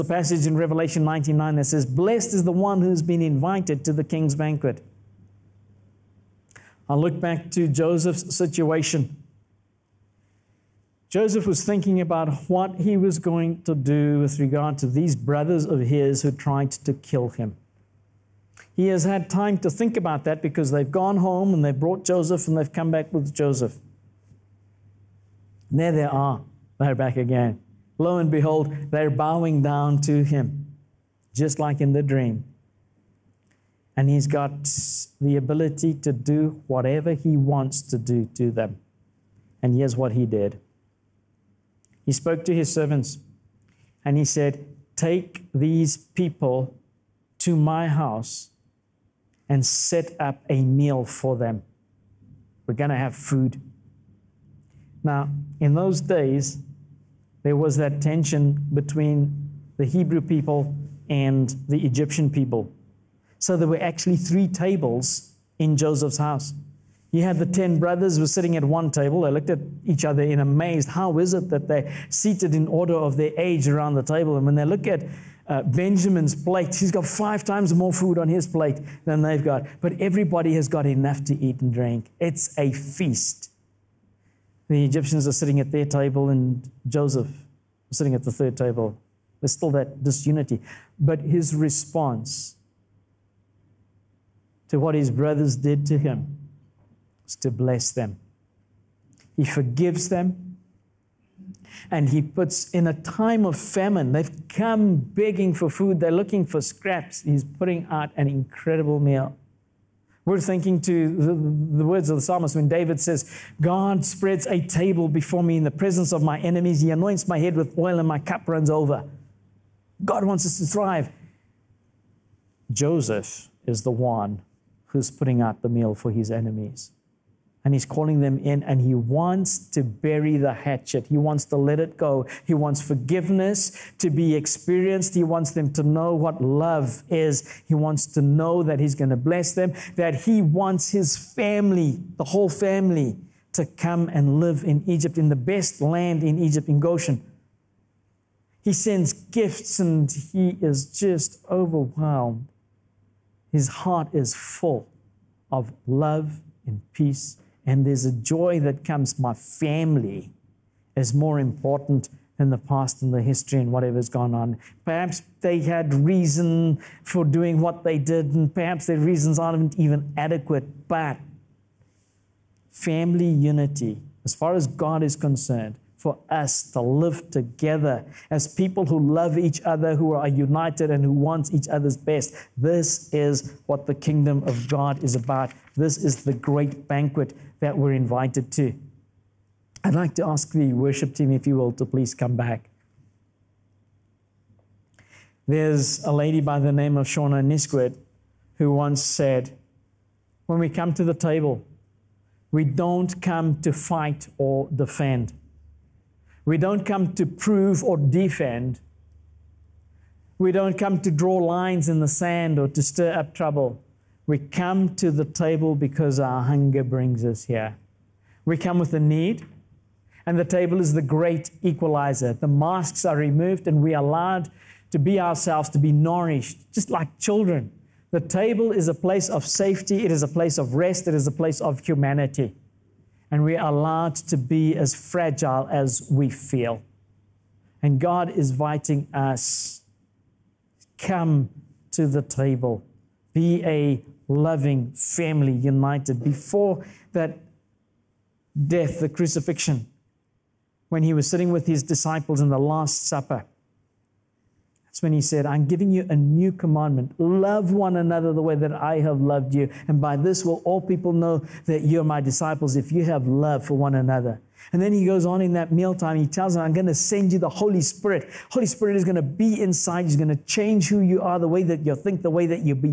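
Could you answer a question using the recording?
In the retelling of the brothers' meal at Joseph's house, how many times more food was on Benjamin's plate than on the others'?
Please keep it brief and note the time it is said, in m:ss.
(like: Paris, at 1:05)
5, at 1:17.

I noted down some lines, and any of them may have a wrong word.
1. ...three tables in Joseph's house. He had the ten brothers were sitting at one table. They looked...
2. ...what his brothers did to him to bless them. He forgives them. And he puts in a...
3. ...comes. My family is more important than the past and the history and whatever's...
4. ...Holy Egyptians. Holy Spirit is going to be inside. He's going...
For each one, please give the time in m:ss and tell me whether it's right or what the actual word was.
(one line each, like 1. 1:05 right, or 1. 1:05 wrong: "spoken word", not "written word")
1. 1:04 right
2. 1:34 right
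3. 2:38 right
4. 4:27 wrong: "Spirit", not "Egyptians".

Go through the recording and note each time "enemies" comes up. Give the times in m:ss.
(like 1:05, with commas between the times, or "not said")
1:56, 2:06.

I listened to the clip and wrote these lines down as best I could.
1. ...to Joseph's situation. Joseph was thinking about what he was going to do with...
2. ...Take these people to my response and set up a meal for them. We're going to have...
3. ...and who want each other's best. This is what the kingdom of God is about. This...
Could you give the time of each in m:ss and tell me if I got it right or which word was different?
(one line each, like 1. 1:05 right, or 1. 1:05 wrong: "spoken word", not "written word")
1. 0:07 right
2. 0:44 wrong: "house", not "response"
3. 3:00 right.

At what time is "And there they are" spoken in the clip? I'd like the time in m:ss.
0:25.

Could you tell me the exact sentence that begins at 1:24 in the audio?
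The Egyptians are sitting at their table, and Joseph sitting at the third table.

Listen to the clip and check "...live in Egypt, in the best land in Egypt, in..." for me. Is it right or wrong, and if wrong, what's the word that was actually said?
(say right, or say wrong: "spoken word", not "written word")
right.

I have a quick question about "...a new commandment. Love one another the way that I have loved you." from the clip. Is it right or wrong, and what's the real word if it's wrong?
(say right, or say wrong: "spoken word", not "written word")
right.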